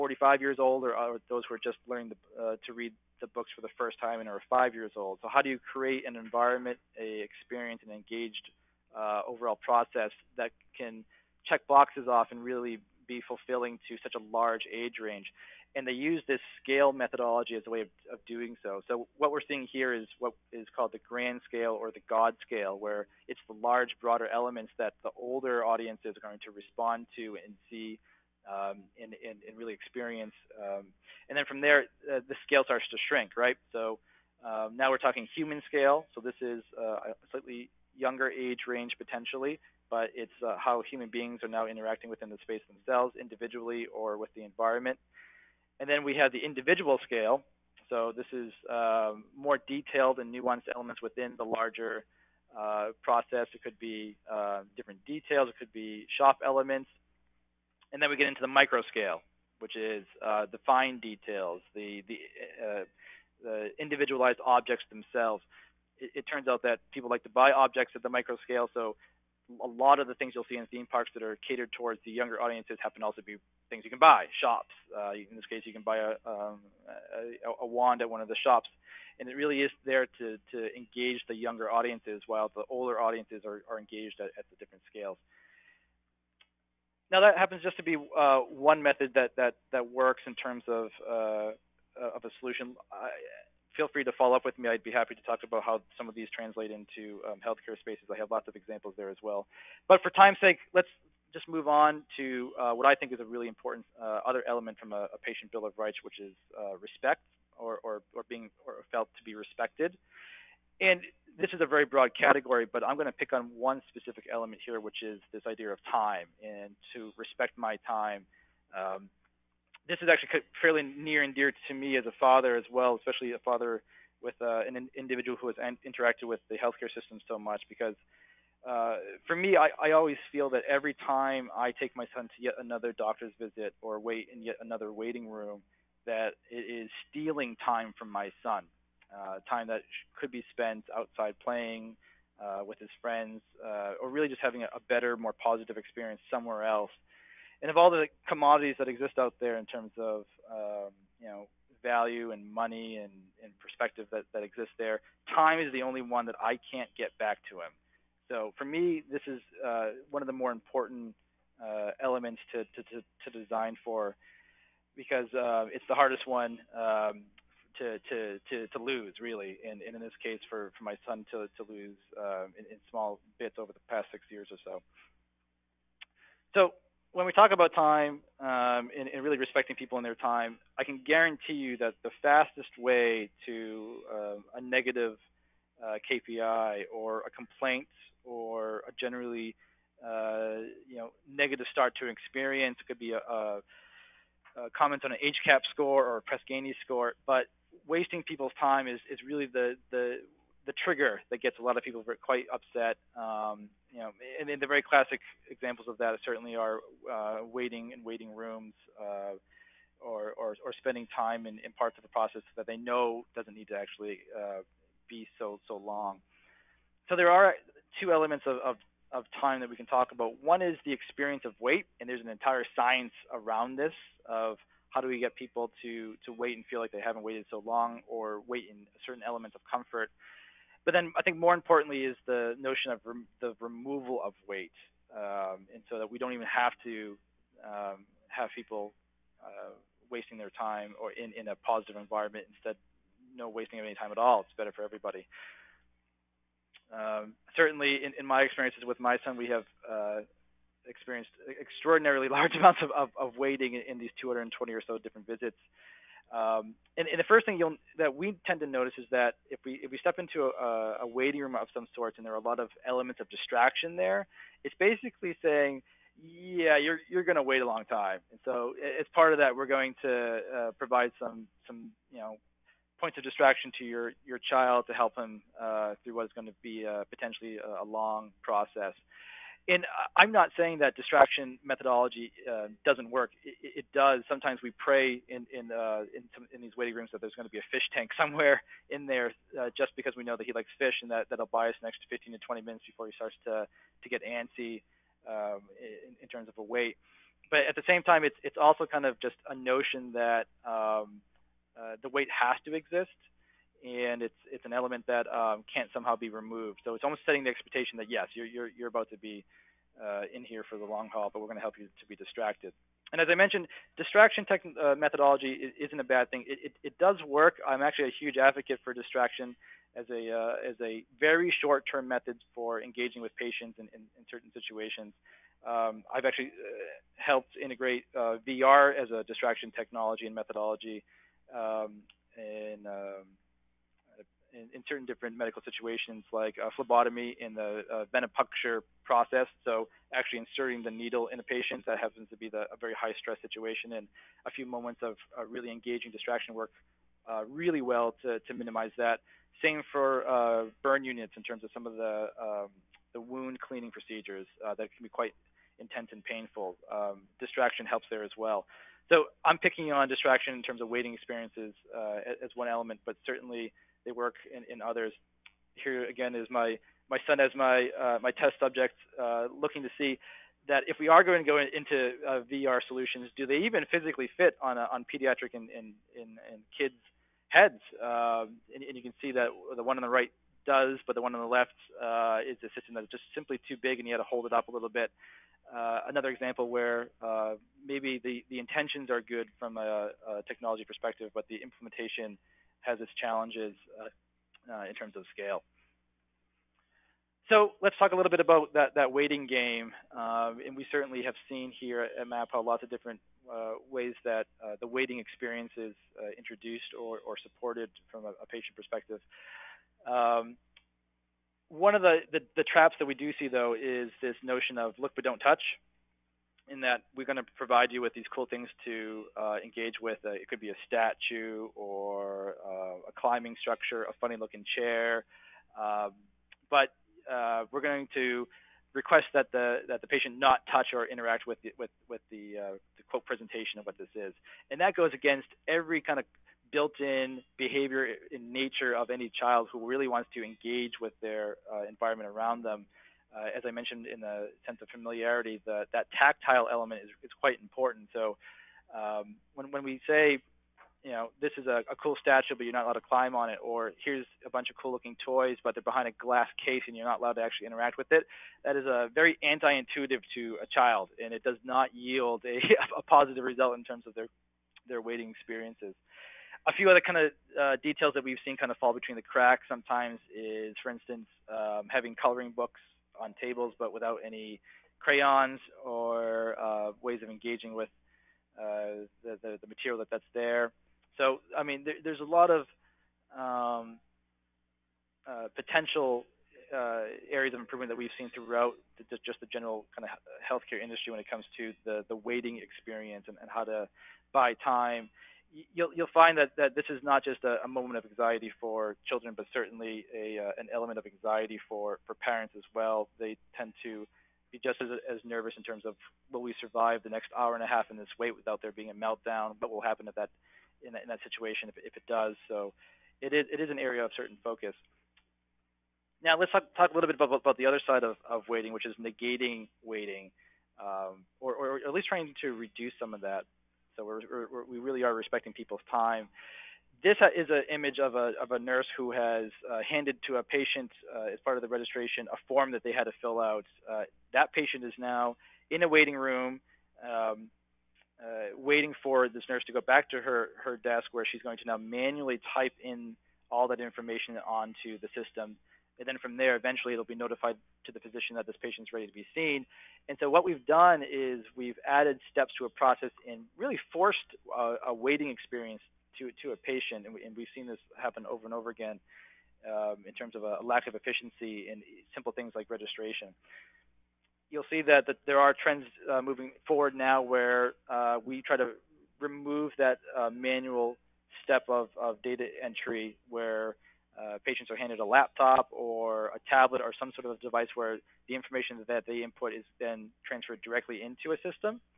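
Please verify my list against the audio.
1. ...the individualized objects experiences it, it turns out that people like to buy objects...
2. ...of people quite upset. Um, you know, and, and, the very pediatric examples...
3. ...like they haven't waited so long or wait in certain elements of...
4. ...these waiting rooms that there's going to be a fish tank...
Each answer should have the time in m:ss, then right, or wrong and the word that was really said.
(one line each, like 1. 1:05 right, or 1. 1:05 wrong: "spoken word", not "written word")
1. 1:03 wrong: "themselves", not "experiences"
2. 3:21 wrong: "classic", not "pediatric"
3. 3:46 right
4. 4:46 right.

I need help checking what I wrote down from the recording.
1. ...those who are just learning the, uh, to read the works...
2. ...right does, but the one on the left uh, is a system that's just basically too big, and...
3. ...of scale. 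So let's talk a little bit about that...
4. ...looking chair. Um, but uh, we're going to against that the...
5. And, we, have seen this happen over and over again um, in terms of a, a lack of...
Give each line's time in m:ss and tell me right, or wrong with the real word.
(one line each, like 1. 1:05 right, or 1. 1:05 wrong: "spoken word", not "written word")
1. 0:01 wrong: "books", not "works"
2. 6:20 wrong: "simply", not "basically"
3. 6:35 right
4. 7:04 wrong: "request", not "against"
5. 9:17 right.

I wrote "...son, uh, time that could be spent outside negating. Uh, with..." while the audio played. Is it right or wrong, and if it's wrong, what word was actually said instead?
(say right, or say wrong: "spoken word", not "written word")
wrong: "playing", not "negating".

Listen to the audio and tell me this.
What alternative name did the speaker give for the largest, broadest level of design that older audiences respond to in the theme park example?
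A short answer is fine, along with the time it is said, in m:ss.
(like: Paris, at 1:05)
God scale, at 0:22.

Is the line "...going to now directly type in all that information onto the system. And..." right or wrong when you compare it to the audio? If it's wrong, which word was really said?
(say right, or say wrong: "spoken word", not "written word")
wrong: "manually", not "directly".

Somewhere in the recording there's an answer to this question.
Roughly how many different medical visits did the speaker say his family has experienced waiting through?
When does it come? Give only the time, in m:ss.
4:14.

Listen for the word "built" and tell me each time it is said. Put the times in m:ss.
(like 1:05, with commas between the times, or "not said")
7:16.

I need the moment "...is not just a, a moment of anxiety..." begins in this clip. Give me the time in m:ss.
8:16.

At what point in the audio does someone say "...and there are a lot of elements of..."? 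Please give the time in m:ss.
4:22.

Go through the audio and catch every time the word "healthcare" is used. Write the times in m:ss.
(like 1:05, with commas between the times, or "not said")
1:37, 2:06, 8:10.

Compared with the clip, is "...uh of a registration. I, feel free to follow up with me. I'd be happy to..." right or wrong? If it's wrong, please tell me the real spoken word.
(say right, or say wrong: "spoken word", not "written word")
wrong: "solution", not "registration".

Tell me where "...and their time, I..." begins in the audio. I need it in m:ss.
2:59.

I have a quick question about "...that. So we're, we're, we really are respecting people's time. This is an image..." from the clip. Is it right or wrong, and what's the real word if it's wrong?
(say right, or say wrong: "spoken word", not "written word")
right.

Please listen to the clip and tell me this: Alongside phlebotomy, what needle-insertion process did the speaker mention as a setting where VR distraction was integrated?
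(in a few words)
Venipuncture.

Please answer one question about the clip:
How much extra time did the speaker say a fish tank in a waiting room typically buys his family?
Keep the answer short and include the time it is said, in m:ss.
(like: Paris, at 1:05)
15 to 20 minutes, at 4:52.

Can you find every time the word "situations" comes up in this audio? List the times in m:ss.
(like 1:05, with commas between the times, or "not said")
5:24, 5:35, 5:43, 8:31.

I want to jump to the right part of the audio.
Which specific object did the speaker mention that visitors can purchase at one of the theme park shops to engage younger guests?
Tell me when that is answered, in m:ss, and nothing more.
1:17.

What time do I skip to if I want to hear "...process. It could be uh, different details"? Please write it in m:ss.
0:53.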